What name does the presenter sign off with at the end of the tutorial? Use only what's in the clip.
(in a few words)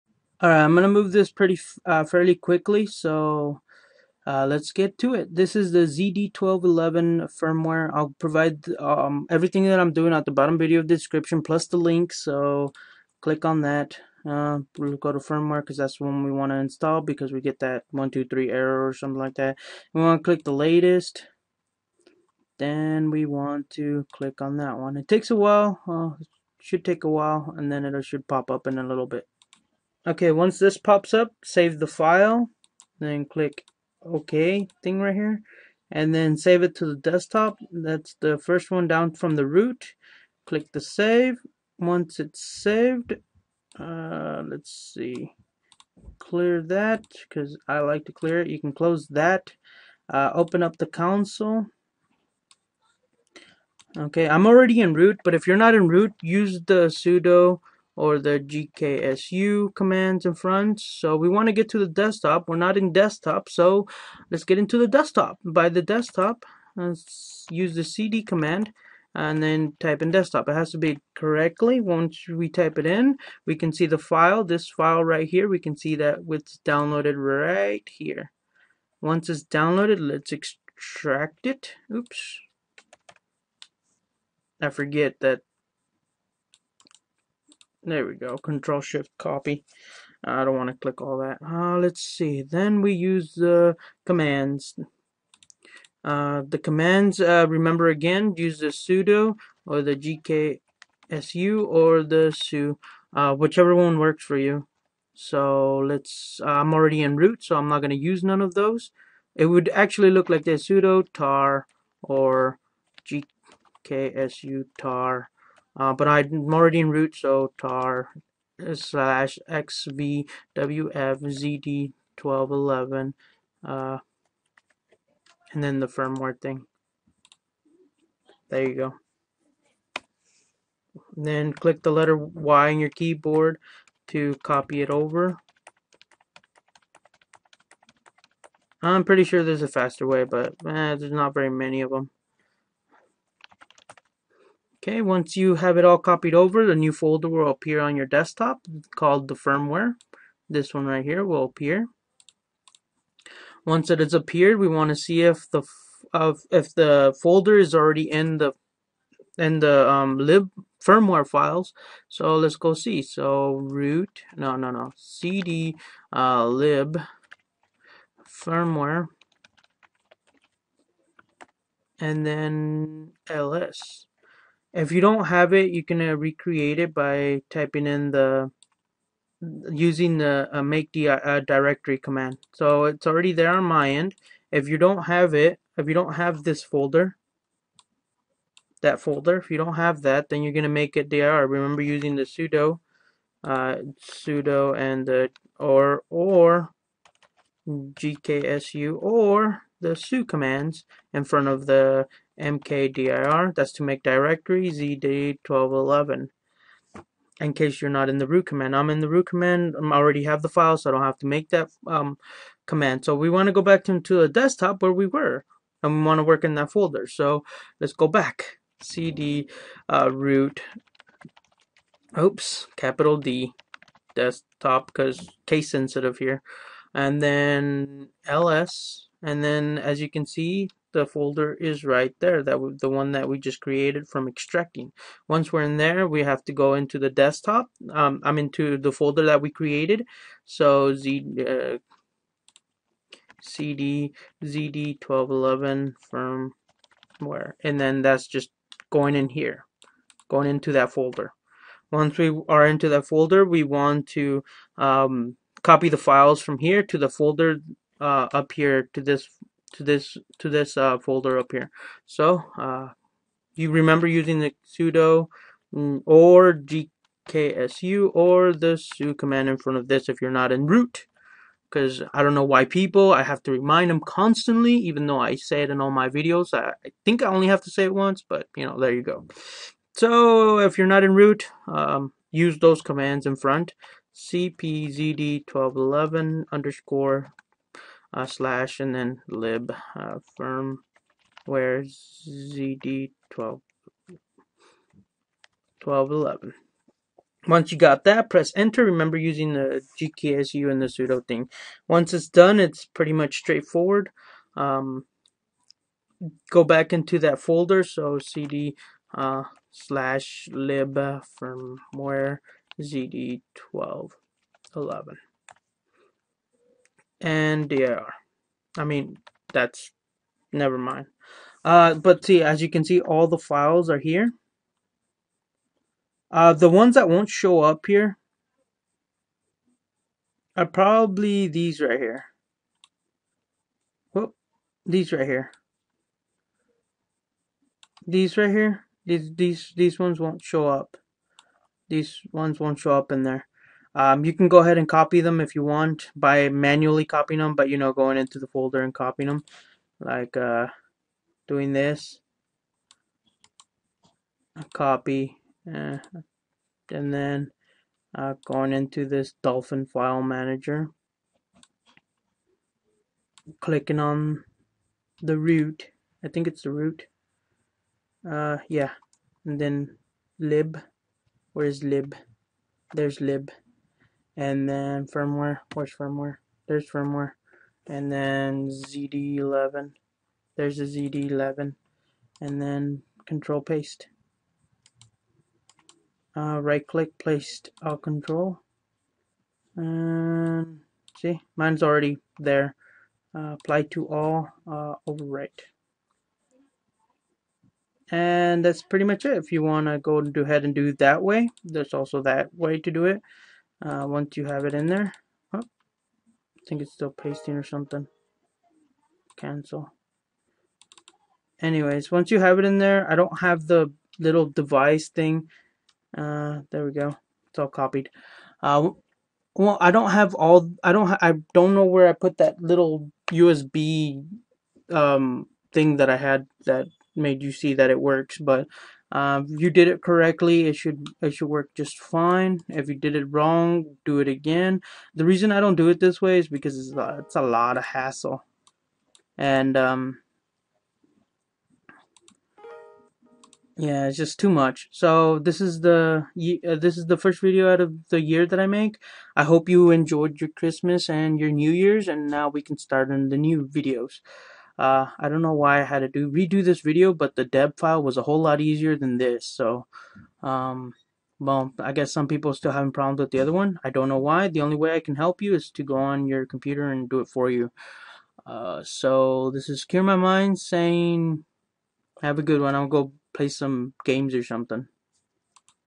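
Cure My Mind.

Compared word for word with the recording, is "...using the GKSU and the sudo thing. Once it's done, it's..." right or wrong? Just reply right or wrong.
right.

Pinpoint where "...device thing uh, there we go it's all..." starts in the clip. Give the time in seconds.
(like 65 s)
414 s.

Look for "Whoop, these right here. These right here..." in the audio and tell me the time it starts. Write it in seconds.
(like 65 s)
334 s.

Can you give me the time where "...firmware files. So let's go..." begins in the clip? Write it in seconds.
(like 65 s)
160 s.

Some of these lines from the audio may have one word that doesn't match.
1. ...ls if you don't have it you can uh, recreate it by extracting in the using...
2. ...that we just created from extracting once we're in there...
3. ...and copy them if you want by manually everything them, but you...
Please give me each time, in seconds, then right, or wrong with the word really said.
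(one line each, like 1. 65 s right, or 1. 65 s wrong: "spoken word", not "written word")
1. 173 s wrong: "typing", not "extracting"
2. 233 s right
3. 344 s wrong: "copying", not "everything".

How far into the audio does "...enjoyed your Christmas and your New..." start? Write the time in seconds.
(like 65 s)
449 s.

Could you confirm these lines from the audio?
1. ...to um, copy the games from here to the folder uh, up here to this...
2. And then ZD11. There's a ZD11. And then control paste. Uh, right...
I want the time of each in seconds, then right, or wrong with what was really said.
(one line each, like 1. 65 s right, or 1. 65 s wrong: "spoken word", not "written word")
1. 254 s wrong: "files", not "games"
2. 377 s right.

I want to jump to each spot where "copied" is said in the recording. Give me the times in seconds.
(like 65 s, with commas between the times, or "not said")
145 s, 417 s.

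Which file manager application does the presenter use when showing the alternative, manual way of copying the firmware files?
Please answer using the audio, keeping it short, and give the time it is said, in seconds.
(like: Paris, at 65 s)
Dolphin, at 359 s.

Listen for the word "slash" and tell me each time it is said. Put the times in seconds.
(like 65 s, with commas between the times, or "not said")
118 s, 288 s, 309 s.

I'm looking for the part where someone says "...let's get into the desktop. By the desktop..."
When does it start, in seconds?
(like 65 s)
64 s.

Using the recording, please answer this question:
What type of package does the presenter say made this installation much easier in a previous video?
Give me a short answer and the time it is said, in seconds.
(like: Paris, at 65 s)
deb file, at 457 s.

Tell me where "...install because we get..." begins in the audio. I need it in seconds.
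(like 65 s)
16 s.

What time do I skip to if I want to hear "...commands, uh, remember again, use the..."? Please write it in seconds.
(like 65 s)
96 s.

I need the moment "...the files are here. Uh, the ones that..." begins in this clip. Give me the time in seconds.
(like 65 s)
323 s.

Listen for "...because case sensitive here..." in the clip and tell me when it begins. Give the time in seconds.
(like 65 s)
224 s.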